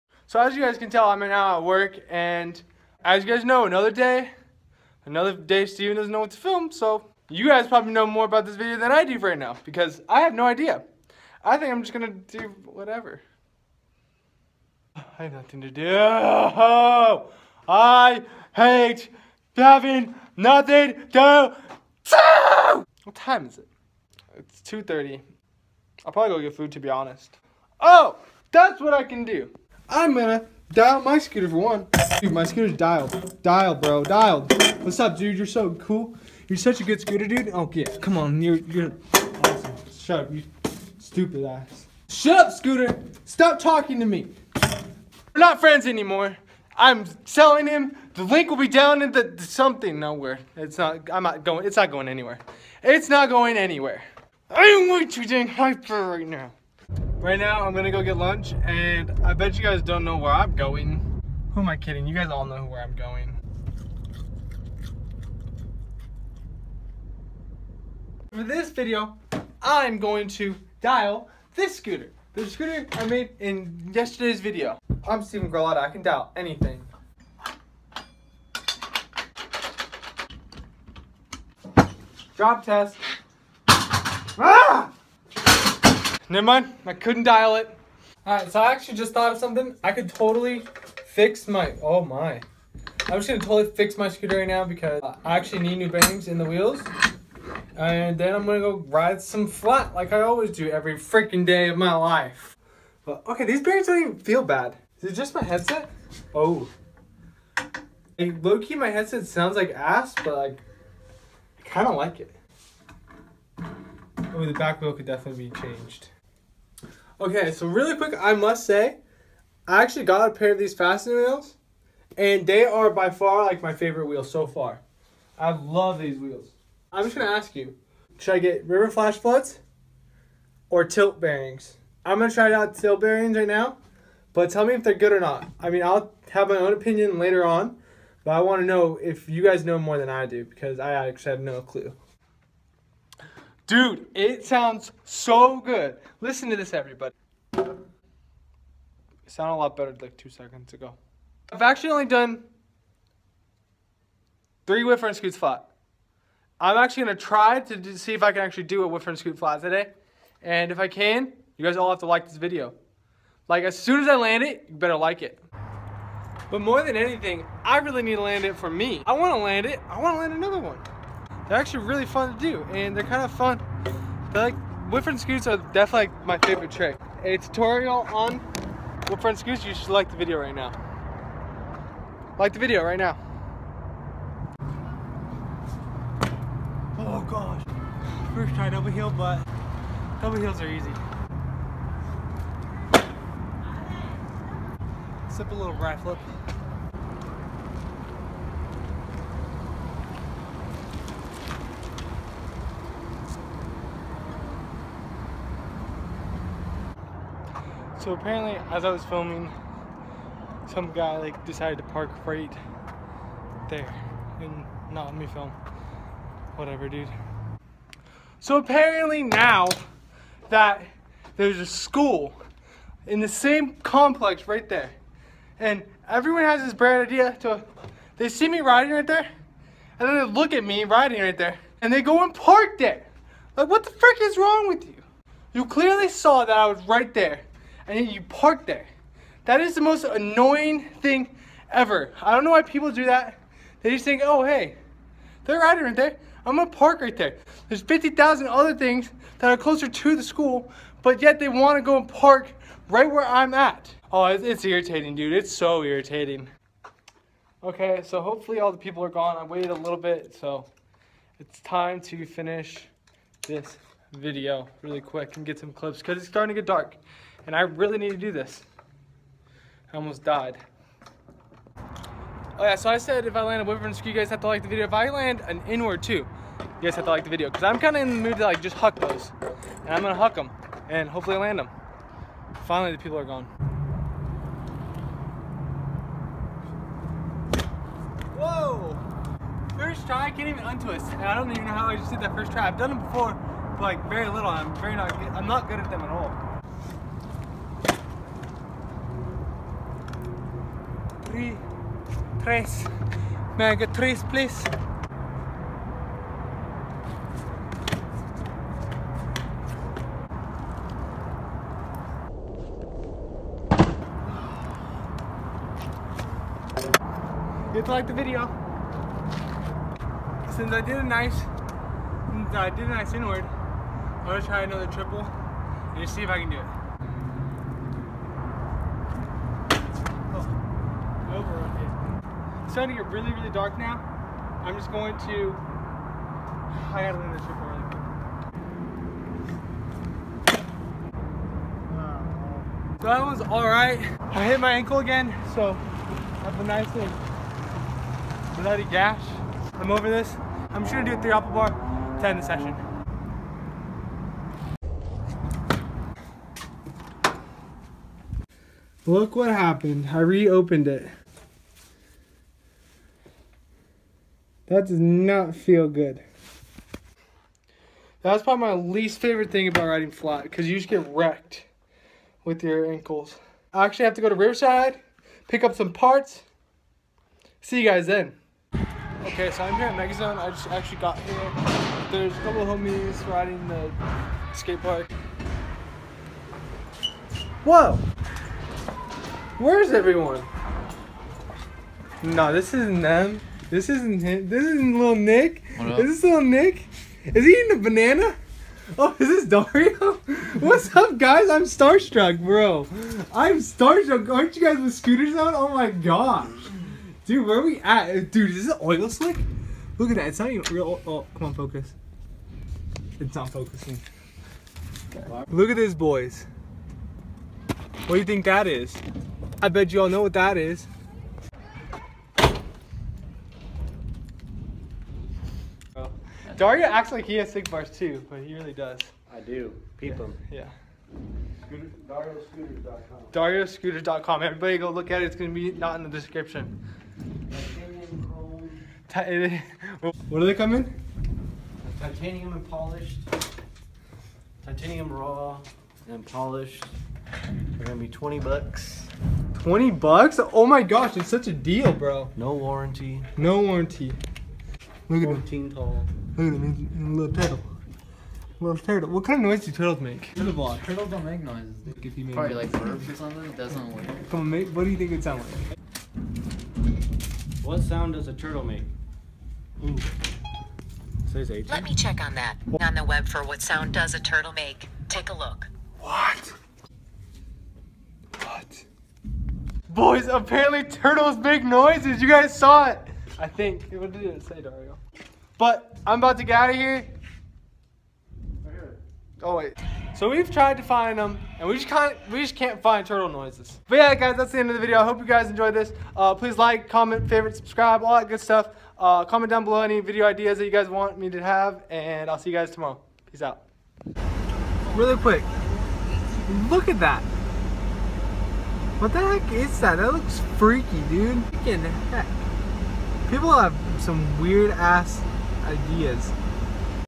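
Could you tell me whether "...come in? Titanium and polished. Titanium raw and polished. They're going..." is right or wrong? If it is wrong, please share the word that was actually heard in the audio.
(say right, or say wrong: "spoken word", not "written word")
right.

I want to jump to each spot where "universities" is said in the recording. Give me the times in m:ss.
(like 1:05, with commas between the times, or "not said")
not said.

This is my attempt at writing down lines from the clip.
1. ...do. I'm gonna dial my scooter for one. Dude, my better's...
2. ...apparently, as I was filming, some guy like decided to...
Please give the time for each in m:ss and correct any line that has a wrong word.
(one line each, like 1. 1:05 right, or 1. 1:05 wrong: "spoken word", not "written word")
1. 0:29 wrong: "scooter", not "better"
2. 3:28 right.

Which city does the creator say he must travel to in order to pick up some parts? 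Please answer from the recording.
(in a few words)
Riverside.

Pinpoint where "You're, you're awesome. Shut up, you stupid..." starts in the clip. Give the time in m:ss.
0:38.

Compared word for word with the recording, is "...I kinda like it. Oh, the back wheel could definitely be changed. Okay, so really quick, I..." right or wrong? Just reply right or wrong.
right.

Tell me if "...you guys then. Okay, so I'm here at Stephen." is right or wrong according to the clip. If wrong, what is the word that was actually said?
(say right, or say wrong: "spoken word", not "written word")
wrong: "Megazone", not "Stephen".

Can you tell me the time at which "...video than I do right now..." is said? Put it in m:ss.
0:08.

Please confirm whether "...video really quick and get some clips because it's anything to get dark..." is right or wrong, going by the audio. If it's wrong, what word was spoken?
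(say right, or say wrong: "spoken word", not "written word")
wrong: "starting", not "anything".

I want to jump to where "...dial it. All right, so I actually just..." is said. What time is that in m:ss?
1:27.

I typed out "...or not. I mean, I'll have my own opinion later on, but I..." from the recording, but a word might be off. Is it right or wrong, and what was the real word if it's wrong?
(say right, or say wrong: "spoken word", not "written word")
right.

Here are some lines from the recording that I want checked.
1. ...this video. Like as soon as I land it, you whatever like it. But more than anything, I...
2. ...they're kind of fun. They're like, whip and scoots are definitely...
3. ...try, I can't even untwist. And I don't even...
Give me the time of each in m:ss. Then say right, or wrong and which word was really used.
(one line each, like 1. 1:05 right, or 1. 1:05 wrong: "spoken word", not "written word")
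1. 2:42 wrong: "better", not "whatever"
2. 2:52 right
3. 4:50 right.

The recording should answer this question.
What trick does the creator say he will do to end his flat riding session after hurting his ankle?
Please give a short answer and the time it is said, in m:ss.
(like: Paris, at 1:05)
Three apple bar, at 5:51.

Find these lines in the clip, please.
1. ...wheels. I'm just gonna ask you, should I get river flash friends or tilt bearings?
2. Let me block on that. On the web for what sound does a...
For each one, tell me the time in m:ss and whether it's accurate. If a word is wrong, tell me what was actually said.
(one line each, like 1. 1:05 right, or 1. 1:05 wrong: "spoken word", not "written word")
1. 2:06 wrong: "floods", not "friends"
2. 7:51 wrong: "check", not "block".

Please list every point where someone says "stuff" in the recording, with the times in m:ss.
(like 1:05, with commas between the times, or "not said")
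8:18.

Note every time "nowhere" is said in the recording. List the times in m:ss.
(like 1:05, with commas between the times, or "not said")
0:49.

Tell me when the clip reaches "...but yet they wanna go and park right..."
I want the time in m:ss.
4:11.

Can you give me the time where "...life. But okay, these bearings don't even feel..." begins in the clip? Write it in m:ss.
1:41.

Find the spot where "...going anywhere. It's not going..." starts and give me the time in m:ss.
0:51.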